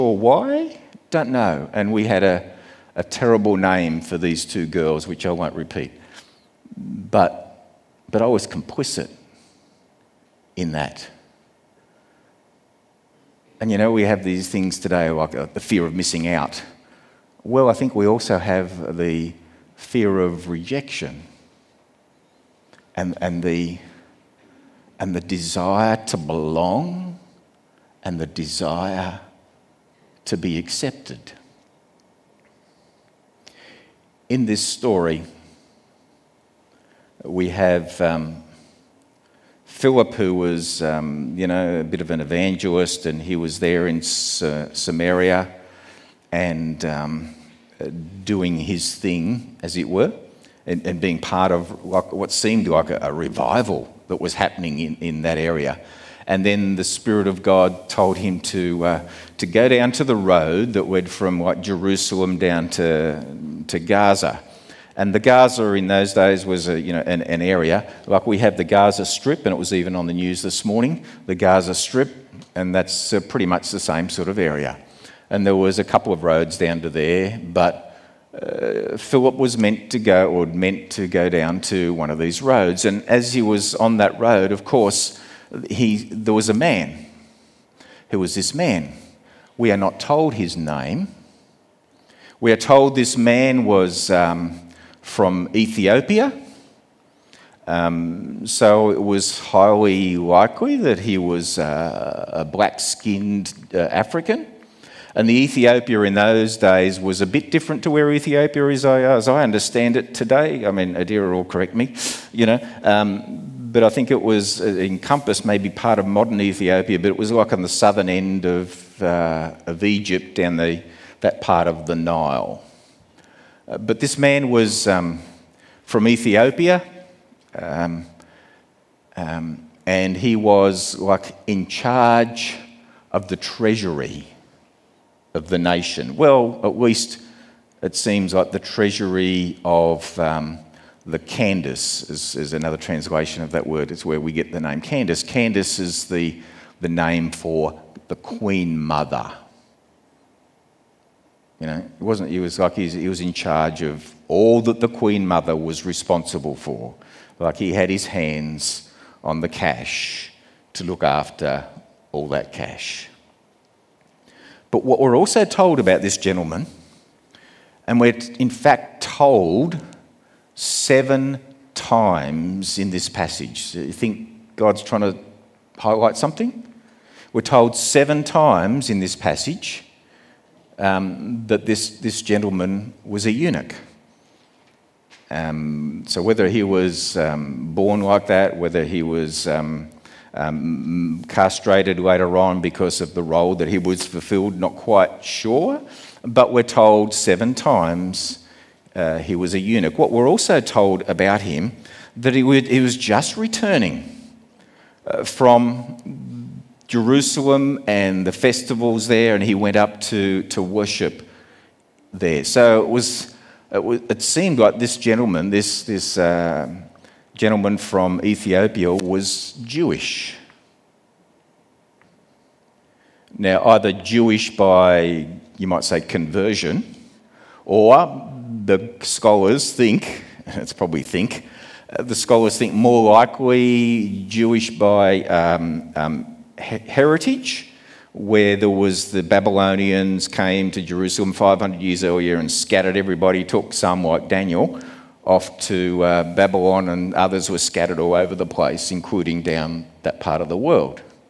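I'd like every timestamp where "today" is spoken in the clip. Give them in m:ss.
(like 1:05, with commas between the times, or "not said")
0:14, 1:50.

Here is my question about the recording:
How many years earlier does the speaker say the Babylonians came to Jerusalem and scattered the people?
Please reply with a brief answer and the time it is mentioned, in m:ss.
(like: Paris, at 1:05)
500, at 4:01.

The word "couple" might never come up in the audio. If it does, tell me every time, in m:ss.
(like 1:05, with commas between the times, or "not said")
1:15.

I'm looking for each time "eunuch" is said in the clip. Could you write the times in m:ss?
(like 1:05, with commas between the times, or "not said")
3:03, 3:19.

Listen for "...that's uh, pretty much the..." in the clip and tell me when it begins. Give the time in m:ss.
1:12.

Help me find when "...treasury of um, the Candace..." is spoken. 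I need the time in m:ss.
2:18.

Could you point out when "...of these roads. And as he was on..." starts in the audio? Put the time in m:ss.
1:22.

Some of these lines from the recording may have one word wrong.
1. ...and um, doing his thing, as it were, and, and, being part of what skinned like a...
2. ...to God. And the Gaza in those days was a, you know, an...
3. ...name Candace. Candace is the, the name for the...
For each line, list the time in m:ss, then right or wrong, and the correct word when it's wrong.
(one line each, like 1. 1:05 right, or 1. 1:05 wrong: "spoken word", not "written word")
1. 0:46 wrong: "seemed", not "skinned"
2. 1:03 wrong: "Gaza", not "God"
3. 2:24 right.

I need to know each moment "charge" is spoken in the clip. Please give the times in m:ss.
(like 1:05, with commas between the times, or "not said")
2:11, 2:33.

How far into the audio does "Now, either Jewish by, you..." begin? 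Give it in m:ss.
3:43.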